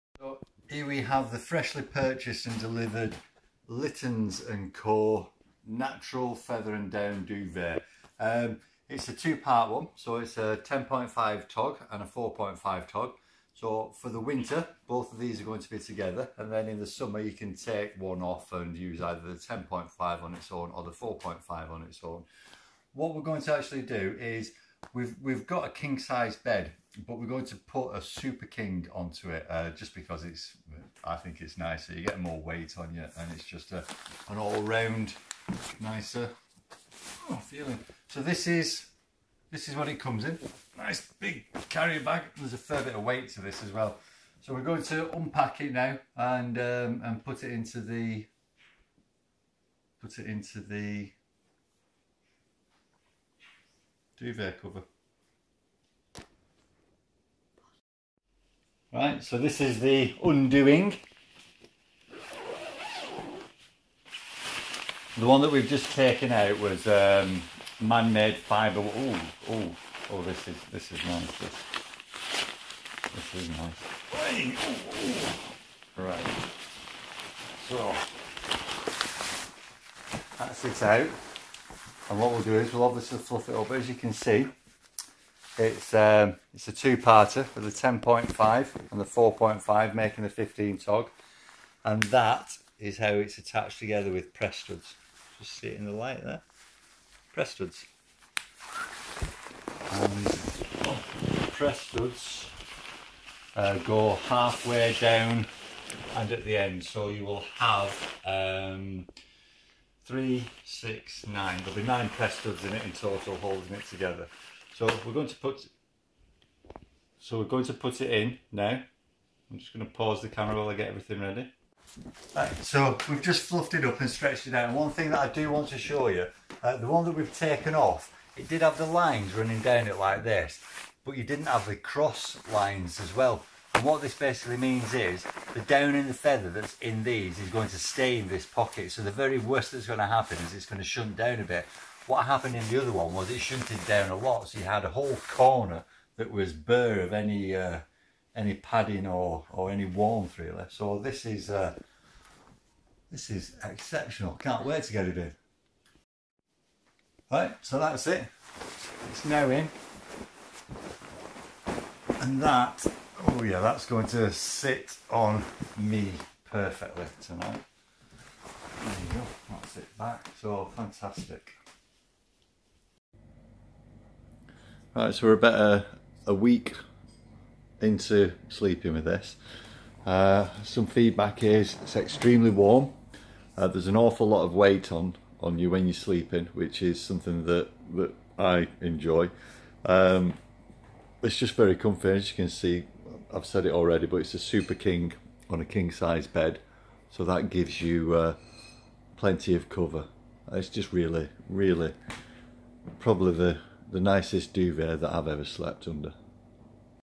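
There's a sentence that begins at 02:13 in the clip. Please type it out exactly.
And what this basically means is the down in the feather that's in these is going to stay in this pocket.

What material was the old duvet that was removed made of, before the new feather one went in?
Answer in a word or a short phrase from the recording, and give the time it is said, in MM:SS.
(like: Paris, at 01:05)
man-made fibre, at 01:07.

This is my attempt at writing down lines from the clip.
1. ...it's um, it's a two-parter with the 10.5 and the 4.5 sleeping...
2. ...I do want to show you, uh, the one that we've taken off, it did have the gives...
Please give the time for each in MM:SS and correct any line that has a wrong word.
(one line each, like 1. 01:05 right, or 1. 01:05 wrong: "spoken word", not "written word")
1. 01:25 wrong: "making", not "sleeping"
2. 02:05 wrong: "lines", not "gives".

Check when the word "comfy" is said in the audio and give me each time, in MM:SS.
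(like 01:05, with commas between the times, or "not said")
03:11.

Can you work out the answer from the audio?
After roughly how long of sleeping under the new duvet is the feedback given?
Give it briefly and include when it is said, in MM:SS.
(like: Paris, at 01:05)
a week, at 02:56.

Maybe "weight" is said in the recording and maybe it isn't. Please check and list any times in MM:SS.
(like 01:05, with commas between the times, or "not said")
00:32, 00:43, 03:04.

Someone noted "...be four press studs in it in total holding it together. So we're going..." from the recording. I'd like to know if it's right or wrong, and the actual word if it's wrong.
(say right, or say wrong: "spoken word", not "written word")
wrong: "nine", not "four".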